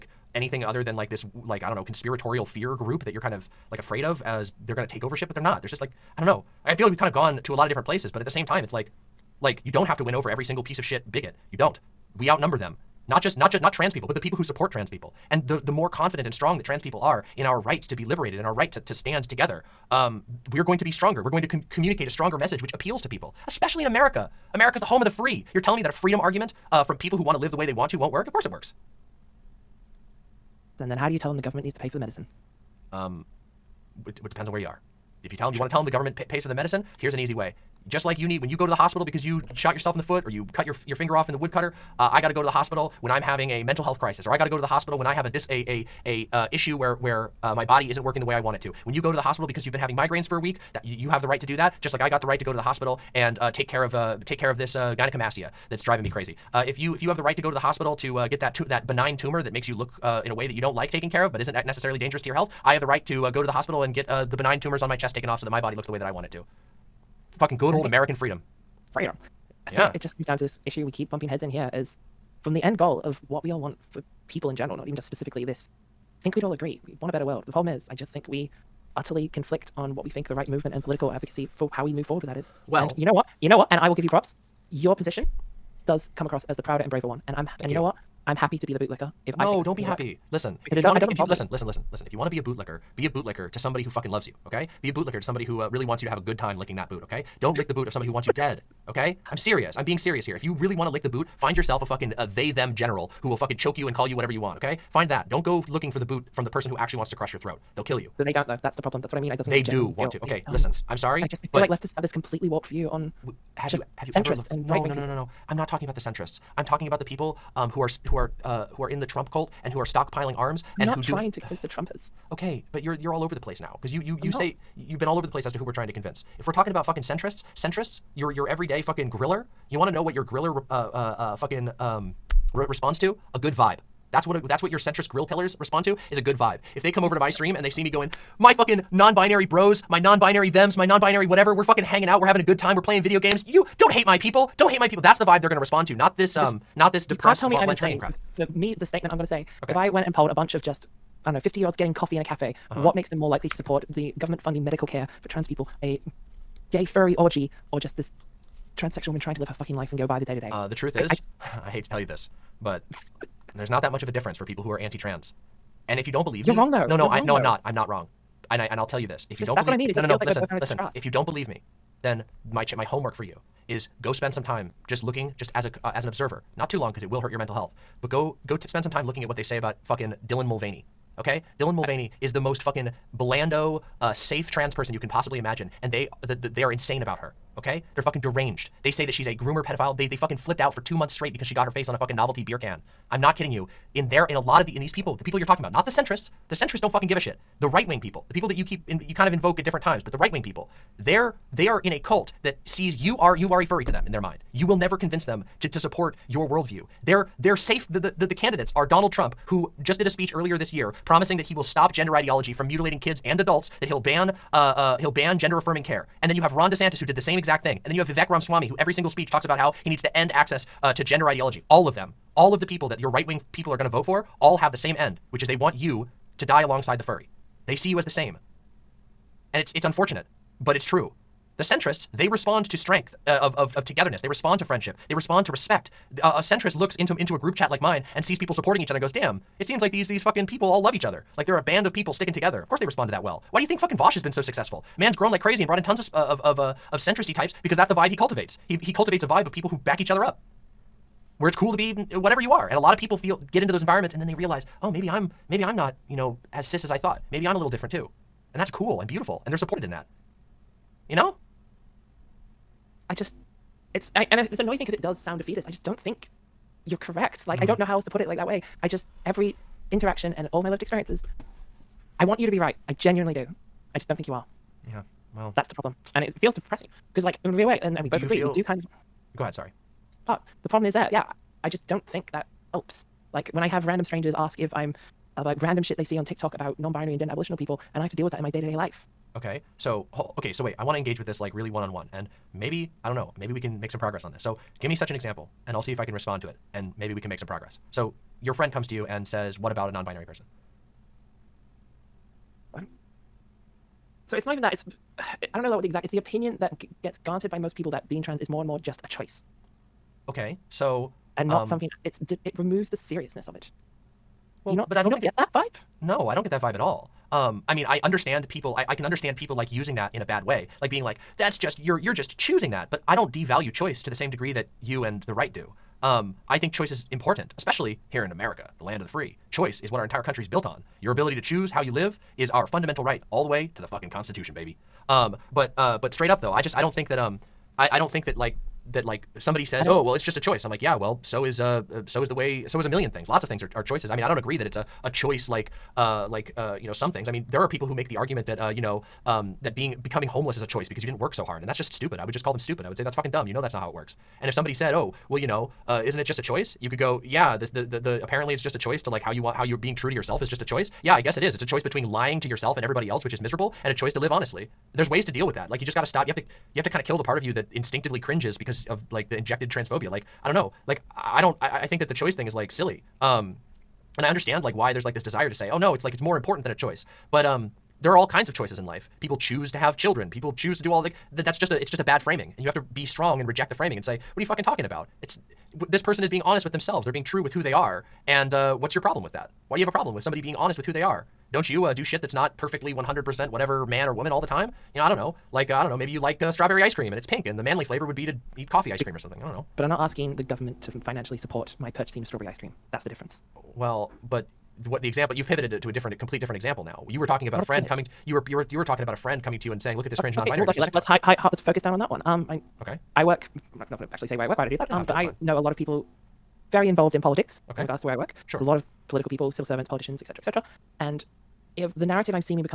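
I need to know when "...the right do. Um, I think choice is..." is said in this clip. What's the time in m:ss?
5:25.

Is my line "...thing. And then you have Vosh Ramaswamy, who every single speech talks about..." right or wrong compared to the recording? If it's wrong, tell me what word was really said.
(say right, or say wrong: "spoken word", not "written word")
wrong: "Vivek", not "Vosh".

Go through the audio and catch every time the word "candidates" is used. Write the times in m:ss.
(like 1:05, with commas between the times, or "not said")
3:28.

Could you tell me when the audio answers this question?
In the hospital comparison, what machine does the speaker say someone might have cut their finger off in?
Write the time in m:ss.
0:41.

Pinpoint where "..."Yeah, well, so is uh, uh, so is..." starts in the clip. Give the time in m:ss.
5:40.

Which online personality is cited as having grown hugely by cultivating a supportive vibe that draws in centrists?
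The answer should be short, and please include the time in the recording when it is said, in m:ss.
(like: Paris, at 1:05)
Vosh, at 4:03.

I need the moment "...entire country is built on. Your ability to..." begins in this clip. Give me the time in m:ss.
5:30.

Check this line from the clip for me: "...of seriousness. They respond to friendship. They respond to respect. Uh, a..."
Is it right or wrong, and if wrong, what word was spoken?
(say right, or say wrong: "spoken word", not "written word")
wrong: "togetherness", not "seriousness".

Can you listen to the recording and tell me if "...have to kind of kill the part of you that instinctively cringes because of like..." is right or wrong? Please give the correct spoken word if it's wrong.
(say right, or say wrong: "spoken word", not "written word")
right.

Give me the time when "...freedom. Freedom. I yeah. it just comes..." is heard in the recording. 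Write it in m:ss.
1:08.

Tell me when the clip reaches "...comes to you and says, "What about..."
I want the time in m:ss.
4:58.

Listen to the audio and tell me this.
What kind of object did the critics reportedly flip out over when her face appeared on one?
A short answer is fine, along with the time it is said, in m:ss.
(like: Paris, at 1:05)
novelty beer can, at 3:12.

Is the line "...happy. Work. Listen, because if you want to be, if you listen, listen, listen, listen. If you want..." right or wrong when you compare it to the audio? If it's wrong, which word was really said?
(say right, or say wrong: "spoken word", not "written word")
right.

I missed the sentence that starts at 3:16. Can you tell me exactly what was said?
The centrists don't fucking give a shit.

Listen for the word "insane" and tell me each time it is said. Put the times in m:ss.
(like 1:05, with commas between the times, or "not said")
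2:27, 3:06.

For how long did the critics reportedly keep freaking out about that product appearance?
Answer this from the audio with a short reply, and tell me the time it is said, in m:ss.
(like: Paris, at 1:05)
two months, at 3:10.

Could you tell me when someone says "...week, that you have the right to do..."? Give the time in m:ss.
0:50.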